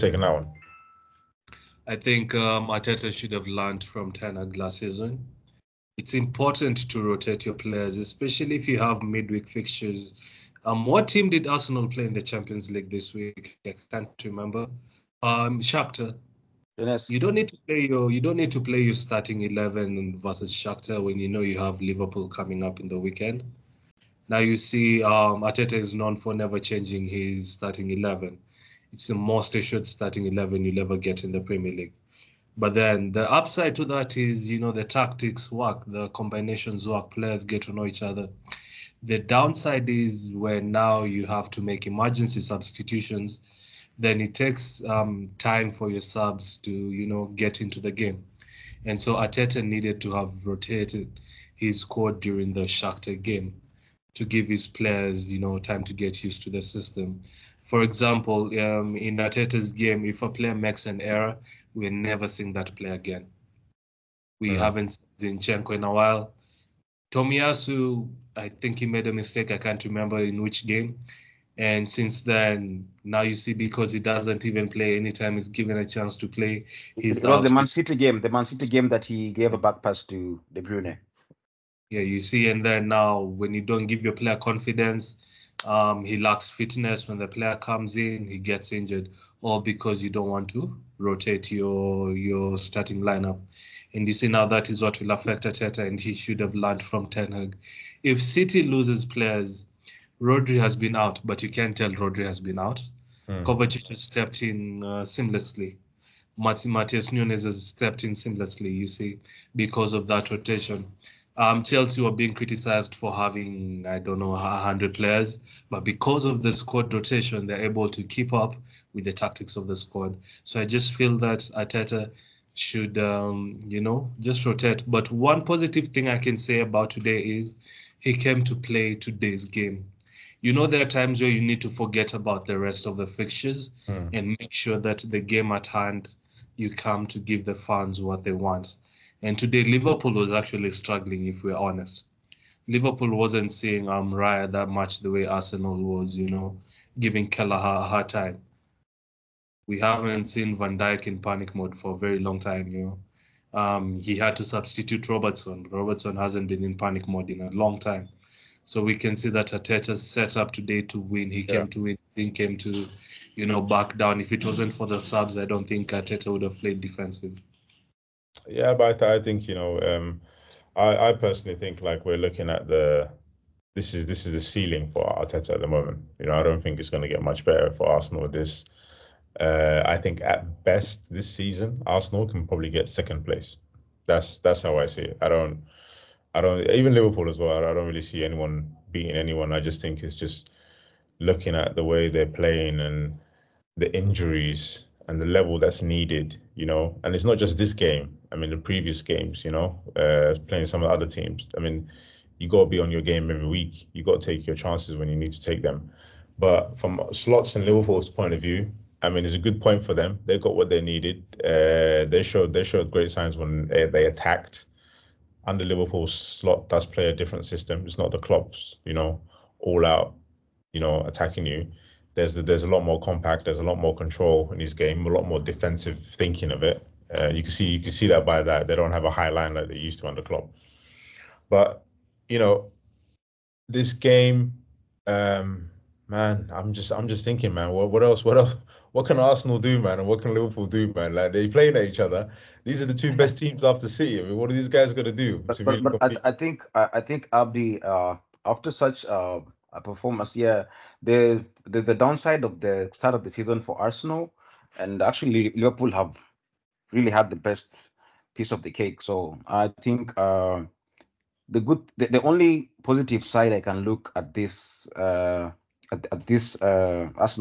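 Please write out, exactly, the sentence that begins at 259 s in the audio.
So I think uh, the good, the, the only positive side I can look at this.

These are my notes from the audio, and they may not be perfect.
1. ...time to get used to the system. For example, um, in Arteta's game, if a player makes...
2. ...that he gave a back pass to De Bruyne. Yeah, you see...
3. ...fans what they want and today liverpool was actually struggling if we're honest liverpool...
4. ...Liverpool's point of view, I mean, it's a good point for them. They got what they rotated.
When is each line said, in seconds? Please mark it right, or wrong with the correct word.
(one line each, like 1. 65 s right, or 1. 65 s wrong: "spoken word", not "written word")
1. 55 s right
2. 78 s right
3. 137 s right
4. 207 s wrong: "needed", not "rotated".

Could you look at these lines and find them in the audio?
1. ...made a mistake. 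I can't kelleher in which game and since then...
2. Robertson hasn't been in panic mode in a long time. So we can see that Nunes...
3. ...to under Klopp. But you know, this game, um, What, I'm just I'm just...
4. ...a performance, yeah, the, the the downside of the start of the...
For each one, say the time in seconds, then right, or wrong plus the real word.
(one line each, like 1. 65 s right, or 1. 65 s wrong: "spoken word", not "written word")
1. 68 s wrong: "remember", not "kelleher"
2. 155 s wrong: "Arteta", not "Nunes"
3. 230 s wrong: "Man", not "What"
4. 249 s right.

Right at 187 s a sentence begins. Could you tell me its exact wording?
I don't really see anyone beating anyone.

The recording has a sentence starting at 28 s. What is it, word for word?
It's the most assured starting eleven you'll ever get in the Premier League.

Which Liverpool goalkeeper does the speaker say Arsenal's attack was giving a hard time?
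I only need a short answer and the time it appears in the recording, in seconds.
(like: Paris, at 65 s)
Kelleher, at 147 s.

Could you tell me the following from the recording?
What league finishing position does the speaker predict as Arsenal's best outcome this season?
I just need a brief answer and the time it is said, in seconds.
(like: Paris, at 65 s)
Second place, at 182 s.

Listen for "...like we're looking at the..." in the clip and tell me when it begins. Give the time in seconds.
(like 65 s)
171 s.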